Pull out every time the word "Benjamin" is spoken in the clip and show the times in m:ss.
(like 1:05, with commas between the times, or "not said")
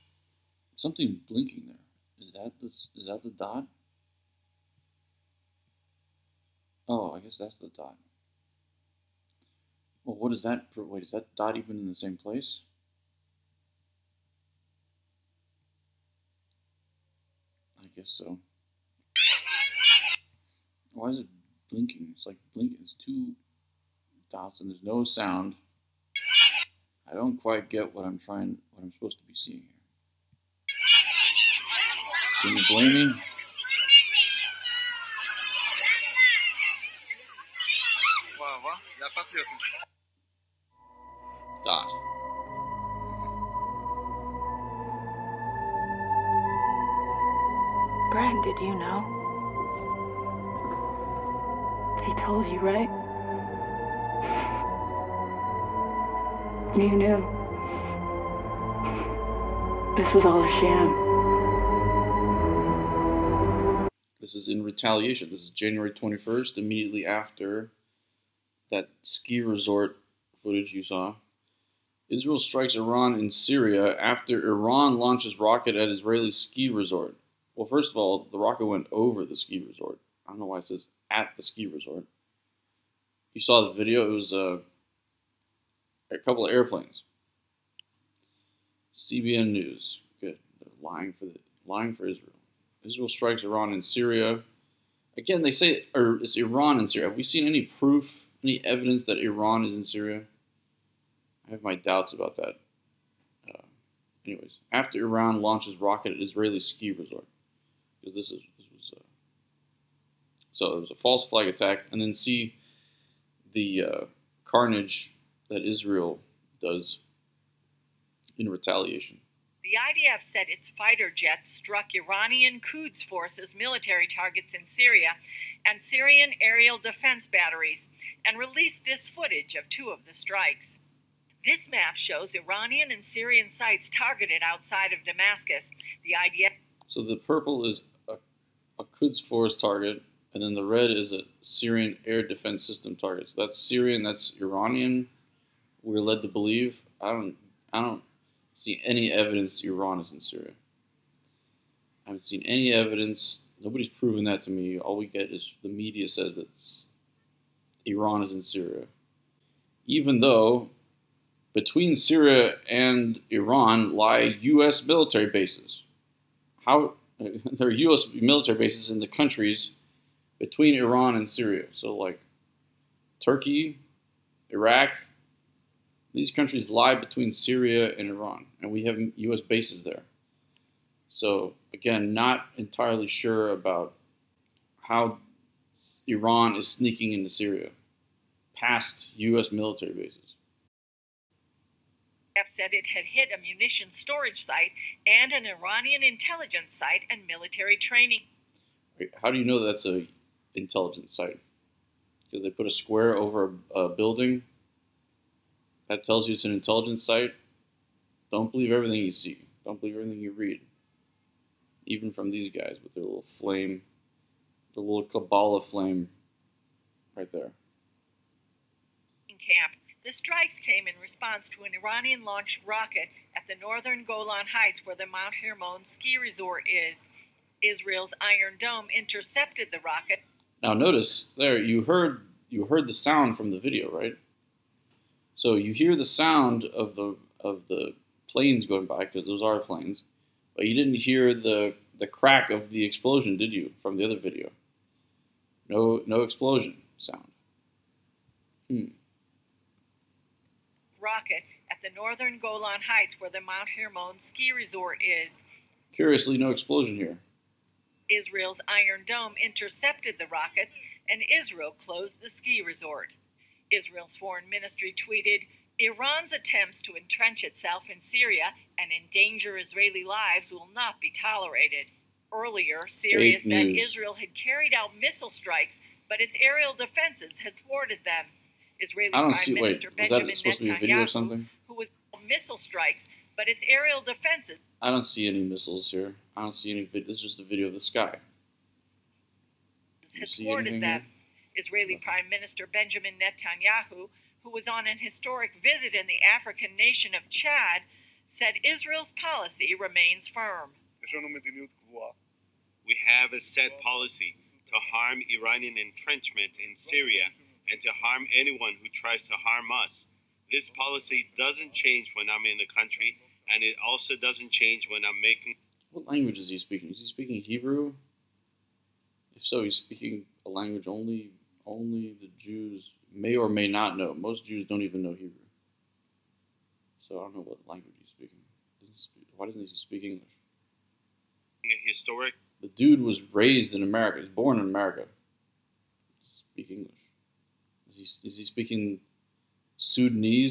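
4:40, 4:52.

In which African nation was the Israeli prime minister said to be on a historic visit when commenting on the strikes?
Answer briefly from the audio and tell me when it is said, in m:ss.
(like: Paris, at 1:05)
Chad, at 4:57.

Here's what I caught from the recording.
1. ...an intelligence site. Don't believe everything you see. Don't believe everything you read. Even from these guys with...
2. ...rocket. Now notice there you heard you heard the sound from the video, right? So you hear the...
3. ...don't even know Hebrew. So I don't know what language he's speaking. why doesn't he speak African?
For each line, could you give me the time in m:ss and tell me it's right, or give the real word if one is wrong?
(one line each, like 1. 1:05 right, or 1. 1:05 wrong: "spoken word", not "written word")
1. 3:26 right
2. 3:49 right
3. 5:24 wrong: "English", not "African".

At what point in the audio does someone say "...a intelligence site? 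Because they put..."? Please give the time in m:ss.
3:19.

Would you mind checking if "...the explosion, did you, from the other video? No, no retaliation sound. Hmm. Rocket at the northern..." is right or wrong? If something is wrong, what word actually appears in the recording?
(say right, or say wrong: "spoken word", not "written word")
wrong: "explosion", not "retaliation".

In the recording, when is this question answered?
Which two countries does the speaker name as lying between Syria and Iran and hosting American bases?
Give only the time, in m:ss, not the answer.
2:53.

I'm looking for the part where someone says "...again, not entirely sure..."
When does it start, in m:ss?
3:01.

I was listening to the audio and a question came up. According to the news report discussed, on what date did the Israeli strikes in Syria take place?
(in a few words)
January 21st.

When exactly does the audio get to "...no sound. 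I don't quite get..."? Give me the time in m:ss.
0:24.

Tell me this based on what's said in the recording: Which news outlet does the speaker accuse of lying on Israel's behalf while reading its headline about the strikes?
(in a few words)
CBN News.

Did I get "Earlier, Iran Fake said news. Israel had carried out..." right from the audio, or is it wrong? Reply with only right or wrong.
wrong.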